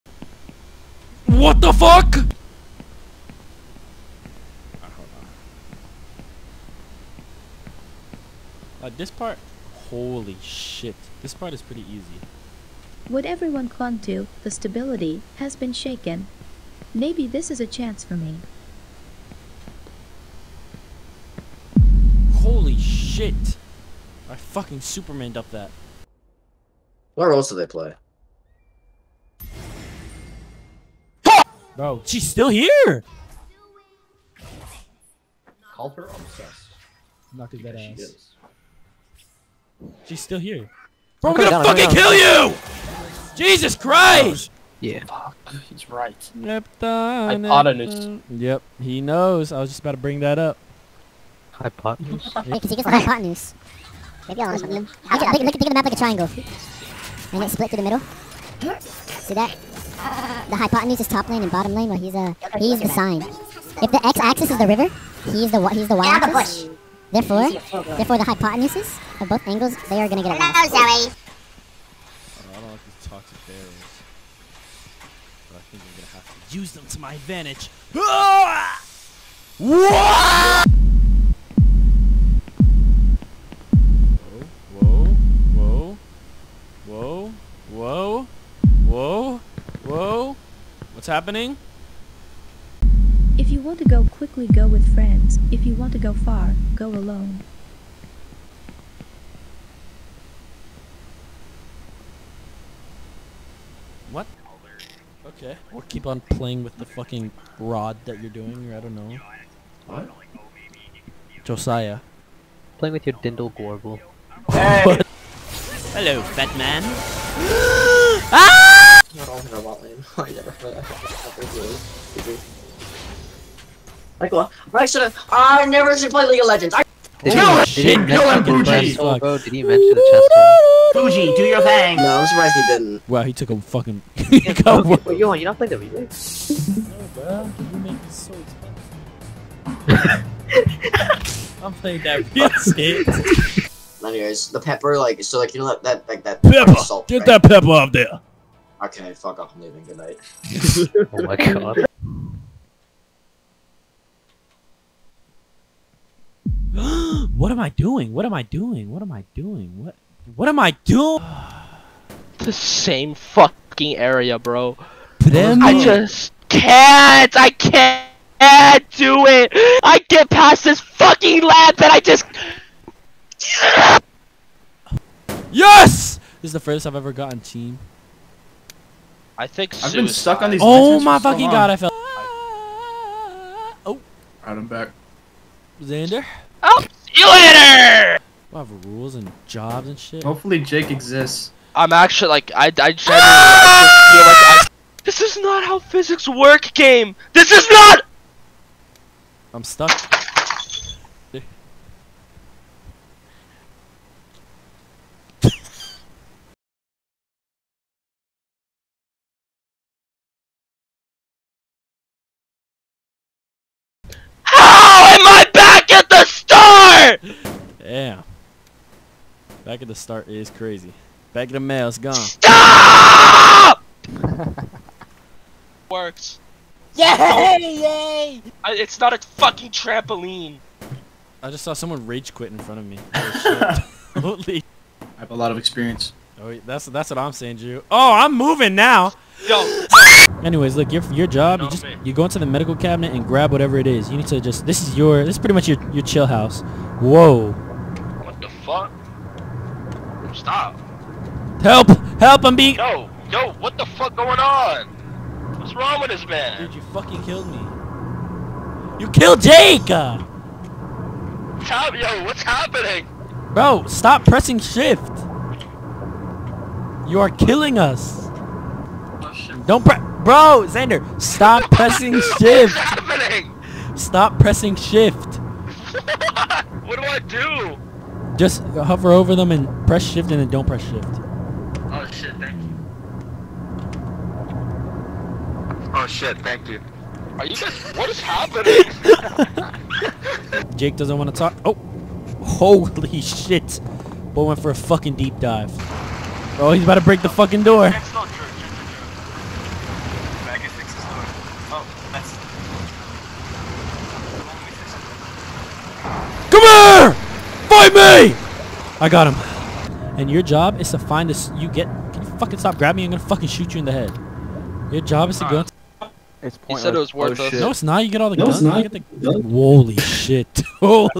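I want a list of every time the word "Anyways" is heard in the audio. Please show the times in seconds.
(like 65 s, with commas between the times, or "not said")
144 s, 240 s.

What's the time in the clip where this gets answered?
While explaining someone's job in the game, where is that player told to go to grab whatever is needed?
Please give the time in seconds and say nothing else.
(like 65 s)
242 s.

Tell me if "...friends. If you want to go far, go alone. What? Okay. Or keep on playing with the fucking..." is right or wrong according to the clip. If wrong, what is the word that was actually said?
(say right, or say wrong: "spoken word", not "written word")
right.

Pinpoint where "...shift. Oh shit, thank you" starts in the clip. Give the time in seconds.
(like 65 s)
280 s.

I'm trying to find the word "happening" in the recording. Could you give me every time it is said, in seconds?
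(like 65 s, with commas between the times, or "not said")
91 s, 262 s, 272 s, 288 s.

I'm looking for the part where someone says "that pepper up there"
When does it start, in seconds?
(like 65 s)
147 s.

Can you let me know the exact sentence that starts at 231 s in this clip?
I just saw someone rage quit in front of me.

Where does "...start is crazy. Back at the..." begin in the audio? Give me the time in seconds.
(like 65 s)
219 s.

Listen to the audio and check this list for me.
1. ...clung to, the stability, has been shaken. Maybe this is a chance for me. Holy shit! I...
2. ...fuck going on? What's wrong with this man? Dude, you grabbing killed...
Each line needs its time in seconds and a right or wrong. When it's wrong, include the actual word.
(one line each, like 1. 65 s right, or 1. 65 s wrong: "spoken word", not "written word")
1. 13 s right
2. 253 s wrong: "fucking", not "grabbing".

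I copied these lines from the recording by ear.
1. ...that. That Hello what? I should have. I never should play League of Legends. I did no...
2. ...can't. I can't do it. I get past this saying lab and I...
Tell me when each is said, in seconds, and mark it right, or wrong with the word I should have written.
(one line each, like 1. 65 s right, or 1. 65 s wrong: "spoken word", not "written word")
1. 120 s wrong: "Like", not "Hello"
2. 166 s wrong: "fucking", not "saying".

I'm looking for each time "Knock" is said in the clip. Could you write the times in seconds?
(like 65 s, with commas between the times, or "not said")
37 s.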